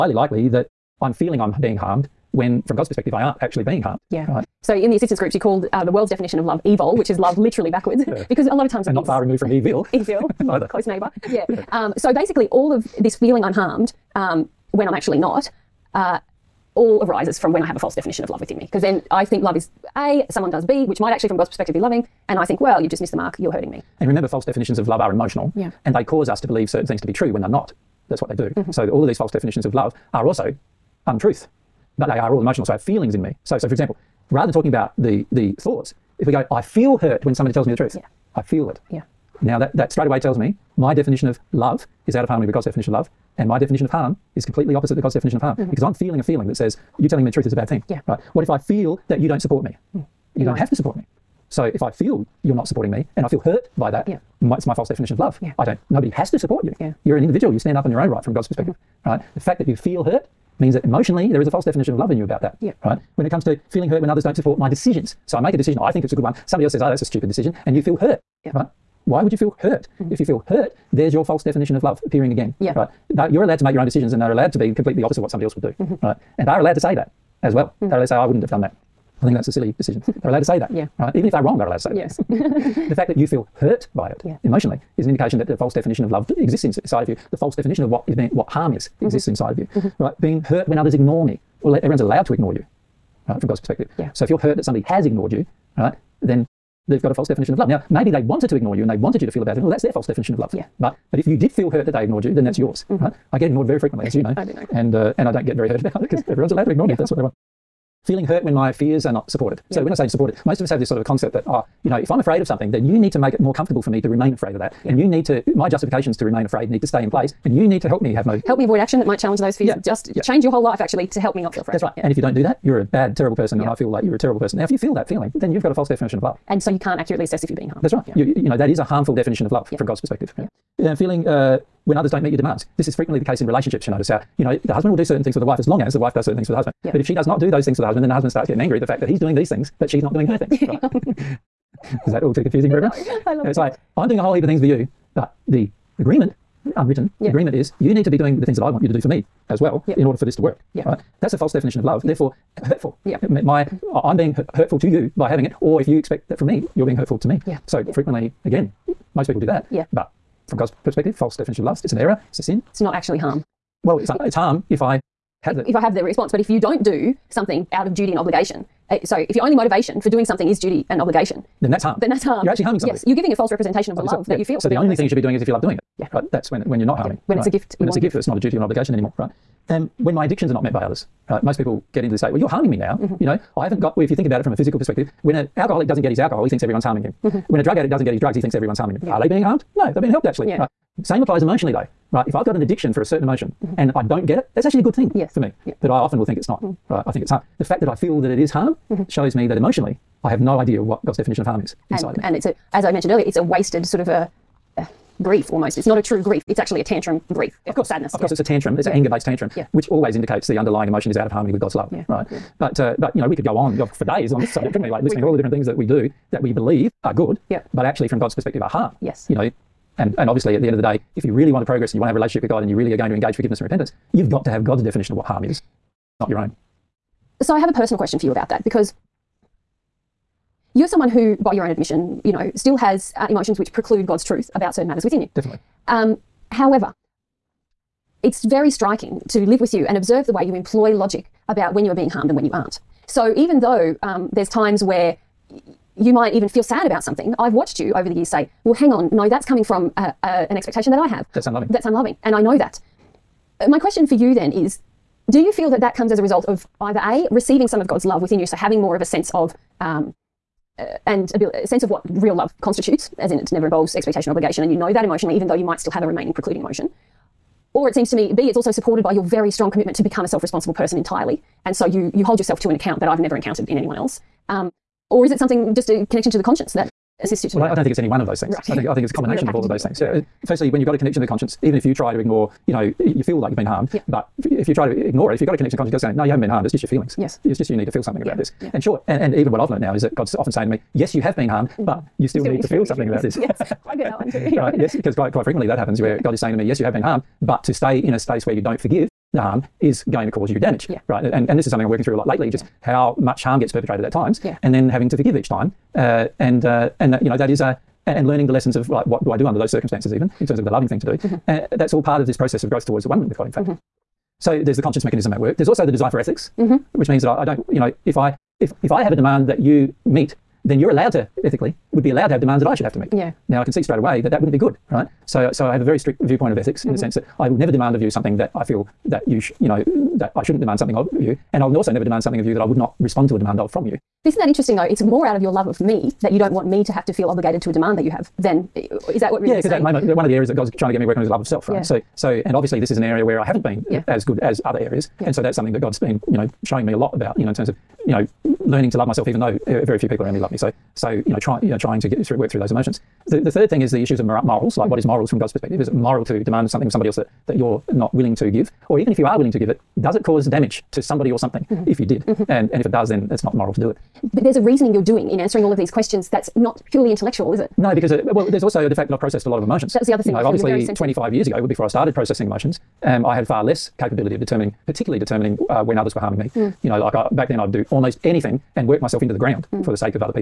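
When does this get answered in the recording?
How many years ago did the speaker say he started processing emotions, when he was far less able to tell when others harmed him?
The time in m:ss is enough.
6:10.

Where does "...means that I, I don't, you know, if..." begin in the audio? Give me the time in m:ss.
5:17.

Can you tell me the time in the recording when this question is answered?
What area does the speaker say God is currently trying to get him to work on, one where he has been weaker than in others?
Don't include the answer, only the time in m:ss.
5:41.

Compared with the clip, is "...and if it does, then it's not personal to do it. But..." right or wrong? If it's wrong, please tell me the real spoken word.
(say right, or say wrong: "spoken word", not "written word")
wrong: "moral", not "personal".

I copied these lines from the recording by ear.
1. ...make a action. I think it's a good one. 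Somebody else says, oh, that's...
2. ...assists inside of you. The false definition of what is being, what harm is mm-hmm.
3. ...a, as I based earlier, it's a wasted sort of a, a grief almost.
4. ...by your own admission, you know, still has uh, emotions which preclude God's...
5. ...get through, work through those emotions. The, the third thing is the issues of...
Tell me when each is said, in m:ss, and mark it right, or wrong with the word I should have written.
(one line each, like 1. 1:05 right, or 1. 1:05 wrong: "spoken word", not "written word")
1. 1:05 wrong: "decision", not "action"
2. 1:26 wrong: "exists", not "assists"
3. 3:22 wrong: "mentioned", not "based"
4. 3:51 right
5. 5:52 right.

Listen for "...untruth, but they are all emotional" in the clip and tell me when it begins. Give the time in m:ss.
0:31.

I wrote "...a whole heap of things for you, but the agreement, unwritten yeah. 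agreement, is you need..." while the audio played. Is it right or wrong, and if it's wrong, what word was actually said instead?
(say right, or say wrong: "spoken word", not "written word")
right.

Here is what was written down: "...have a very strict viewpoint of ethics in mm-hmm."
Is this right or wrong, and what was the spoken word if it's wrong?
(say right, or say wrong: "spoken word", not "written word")
right.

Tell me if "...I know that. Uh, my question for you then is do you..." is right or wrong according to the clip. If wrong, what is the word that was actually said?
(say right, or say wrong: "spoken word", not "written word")
right.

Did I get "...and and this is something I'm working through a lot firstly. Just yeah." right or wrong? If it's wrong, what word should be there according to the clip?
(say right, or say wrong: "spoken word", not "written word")
wrong: "lately", not "firstly".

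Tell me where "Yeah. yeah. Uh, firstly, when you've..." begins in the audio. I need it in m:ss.
4:40.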